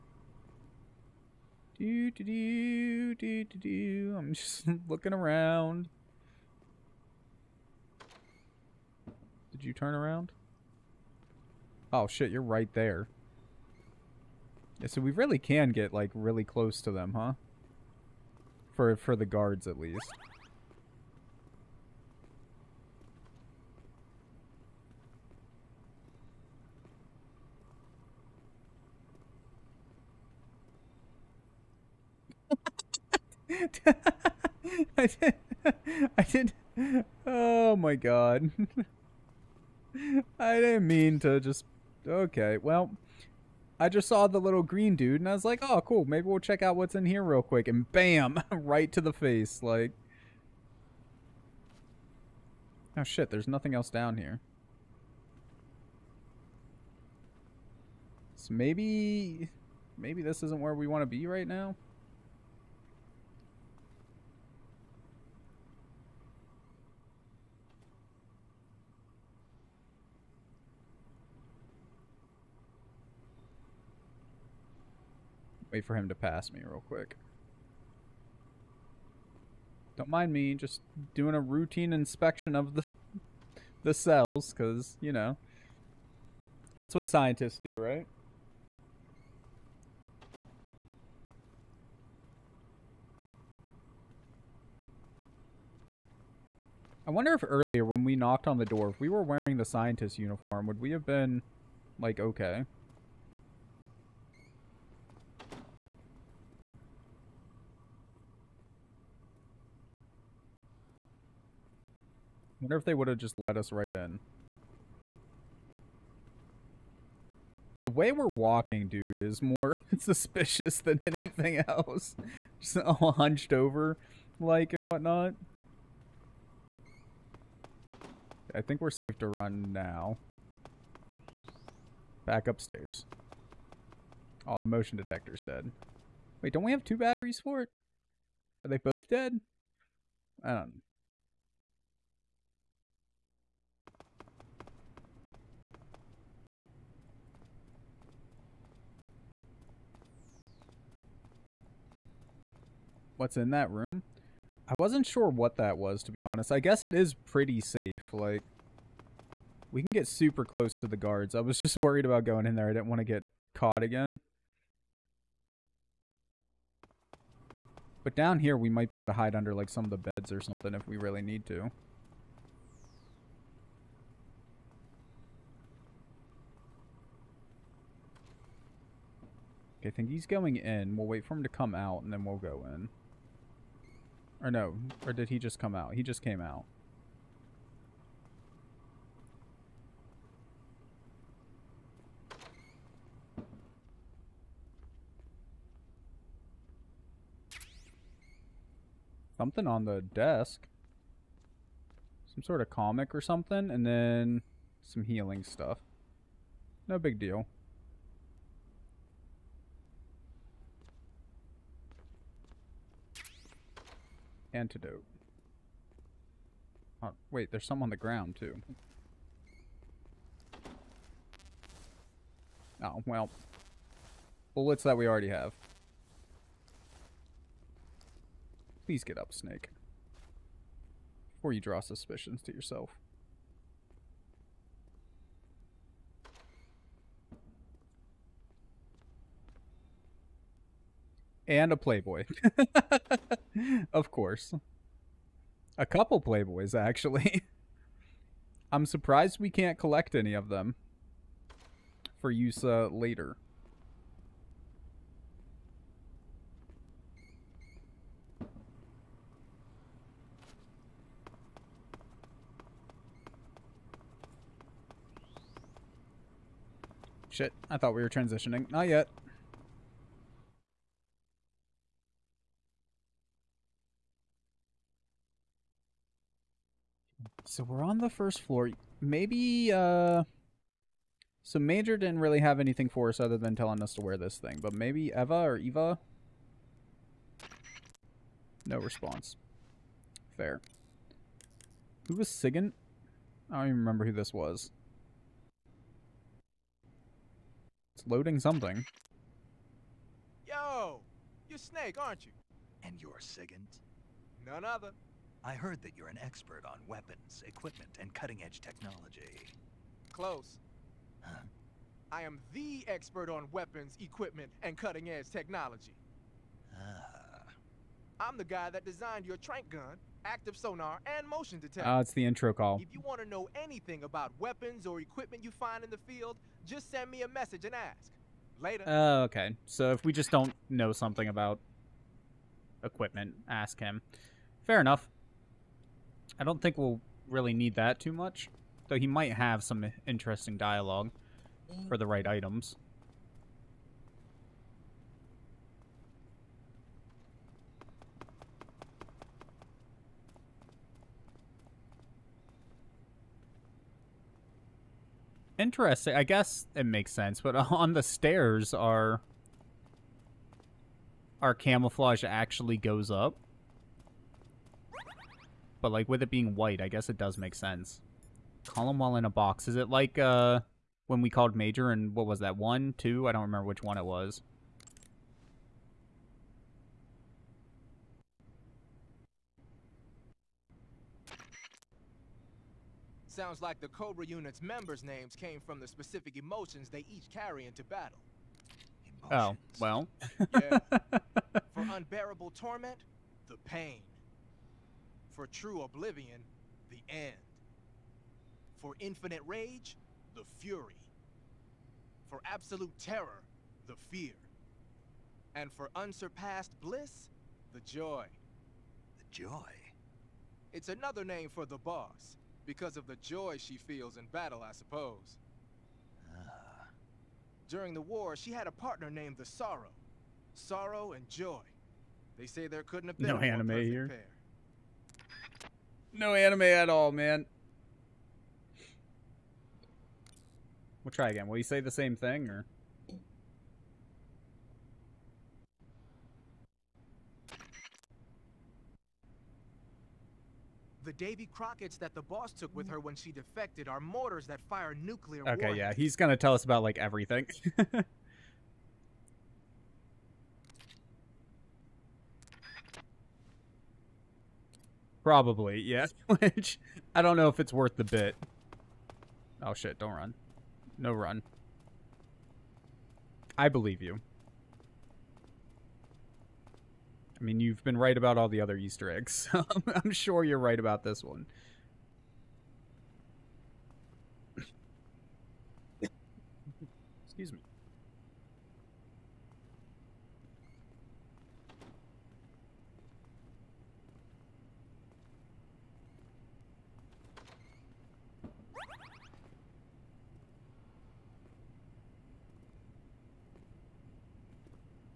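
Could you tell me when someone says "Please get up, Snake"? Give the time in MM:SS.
03:48.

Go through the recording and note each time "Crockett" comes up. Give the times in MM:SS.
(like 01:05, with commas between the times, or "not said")
07:21.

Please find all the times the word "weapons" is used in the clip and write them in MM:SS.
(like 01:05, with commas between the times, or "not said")
05:06, 05:13, 05:24.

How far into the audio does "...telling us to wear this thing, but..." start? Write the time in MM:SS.
04:43.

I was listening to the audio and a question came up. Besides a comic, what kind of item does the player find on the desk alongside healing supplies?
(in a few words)
antidote.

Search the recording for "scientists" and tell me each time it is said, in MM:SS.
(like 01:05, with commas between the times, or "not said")
01:27, 01:39.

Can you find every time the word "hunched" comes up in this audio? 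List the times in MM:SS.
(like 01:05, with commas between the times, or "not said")
02:03.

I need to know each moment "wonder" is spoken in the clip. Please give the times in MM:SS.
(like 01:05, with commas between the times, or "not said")
01:37, 01:52.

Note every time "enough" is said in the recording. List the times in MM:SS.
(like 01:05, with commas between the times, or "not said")
05:34.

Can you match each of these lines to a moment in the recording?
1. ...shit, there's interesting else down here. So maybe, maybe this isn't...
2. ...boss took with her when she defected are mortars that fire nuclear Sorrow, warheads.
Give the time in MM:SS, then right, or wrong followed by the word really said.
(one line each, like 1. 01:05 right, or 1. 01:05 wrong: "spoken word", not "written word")
1. 00:53 wrong: "nothing", not "interesting"
2. 07:22 wrong: "Okay", not "Sorrow".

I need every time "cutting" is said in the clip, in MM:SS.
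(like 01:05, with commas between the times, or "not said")
05:08, 05:14.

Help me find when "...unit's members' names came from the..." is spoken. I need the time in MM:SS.
06:24.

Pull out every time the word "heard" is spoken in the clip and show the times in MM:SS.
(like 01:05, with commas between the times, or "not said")
05:05.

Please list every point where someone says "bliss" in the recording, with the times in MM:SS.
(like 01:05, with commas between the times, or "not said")
06:46.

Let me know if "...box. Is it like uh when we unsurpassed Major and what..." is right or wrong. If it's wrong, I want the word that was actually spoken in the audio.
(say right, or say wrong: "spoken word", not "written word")
wrong: "called", not "unsurpassed".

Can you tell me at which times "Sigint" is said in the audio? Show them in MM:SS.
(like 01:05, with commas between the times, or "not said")
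04:52, 05:03.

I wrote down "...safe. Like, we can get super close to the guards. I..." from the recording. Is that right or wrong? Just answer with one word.
right.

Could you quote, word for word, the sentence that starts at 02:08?
I think we're safe to run now.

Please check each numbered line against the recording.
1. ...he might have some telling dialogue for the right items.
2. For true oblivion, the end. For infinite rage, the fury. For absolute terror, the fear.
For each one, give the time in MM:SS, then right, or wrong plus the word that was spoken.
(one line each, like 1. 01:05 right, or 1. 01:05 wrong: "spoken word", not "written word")
1. 05:38 wrong: "interesting", not "telling"
2. 06:35 right.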